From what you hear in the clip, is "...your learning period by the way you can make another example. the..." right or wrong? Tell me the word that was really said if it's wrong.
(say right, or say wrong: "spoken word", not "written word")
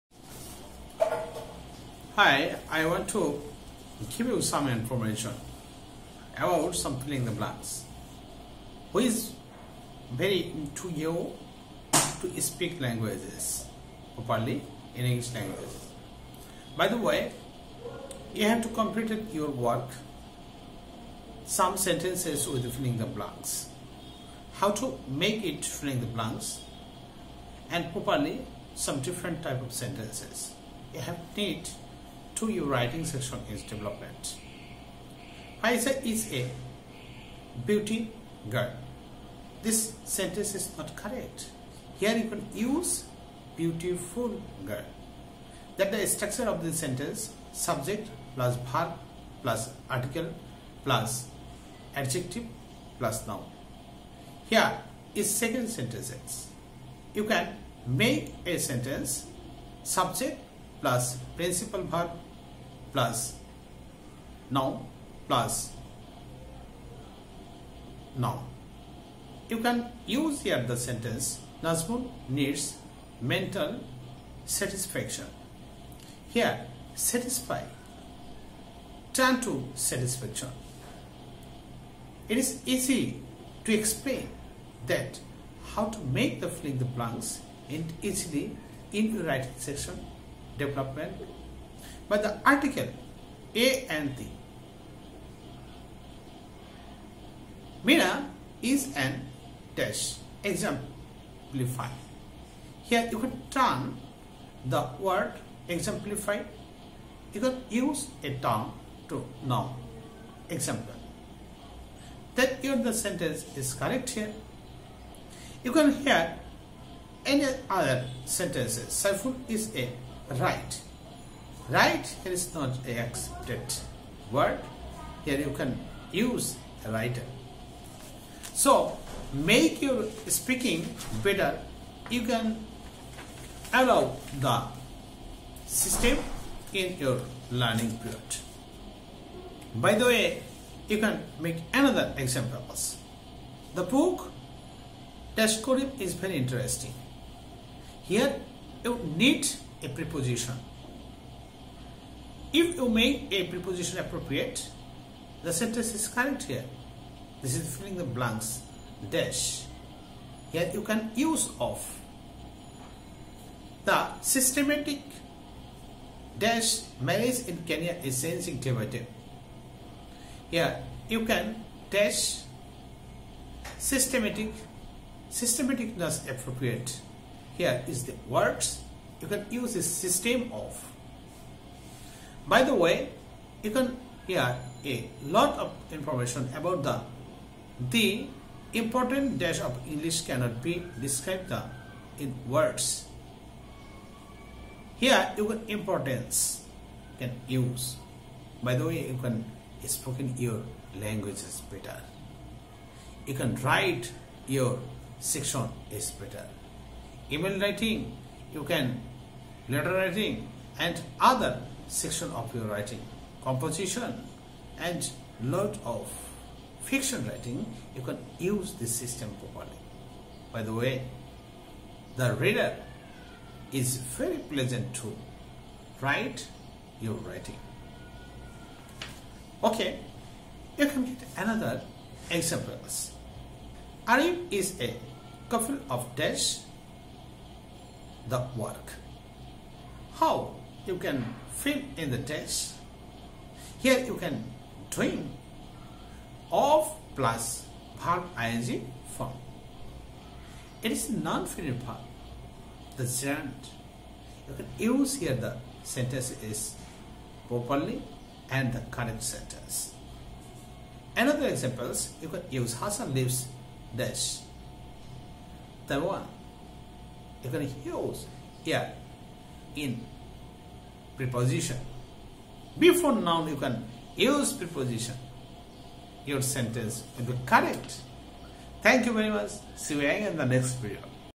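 right.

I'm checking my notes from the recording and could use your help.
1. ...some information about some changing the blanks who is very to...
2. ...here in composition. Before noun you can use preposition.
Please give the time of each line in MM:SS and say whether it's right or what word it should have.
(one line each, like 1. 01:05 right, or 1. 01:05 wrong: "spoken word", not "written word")
1. 00:04 wrong: "filling", not "changing"
2. 04:28 wrong: "preposition", not "composition".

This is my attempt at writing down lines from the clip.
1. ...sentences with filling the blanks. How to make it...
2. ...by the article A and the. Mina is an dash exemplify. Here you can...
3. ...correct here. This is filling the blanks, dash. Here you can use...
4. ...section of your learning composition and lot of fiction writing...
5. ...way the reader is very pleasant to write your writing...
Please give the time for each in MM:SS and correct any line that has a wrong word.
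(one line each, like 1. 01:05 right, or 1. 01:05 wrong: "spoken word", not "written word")
1. 00:21 right
2. 01:32 right
3. 02:36 right
4. 03:31 wrong: "writing", not "learning"
5. 03:40 right.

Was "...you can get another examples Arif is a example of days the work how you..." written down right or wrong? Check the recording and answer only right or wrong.
wrong.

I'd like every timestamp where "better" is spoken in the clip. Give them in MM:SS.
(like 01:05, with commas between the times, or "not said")
02:11, 03:21, 03:26.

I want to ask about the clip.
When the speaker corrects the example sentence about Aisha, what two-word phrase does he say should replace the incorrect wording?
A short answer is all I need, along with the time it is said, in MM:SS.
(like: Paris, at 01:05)
beautiful girl, at 00:43.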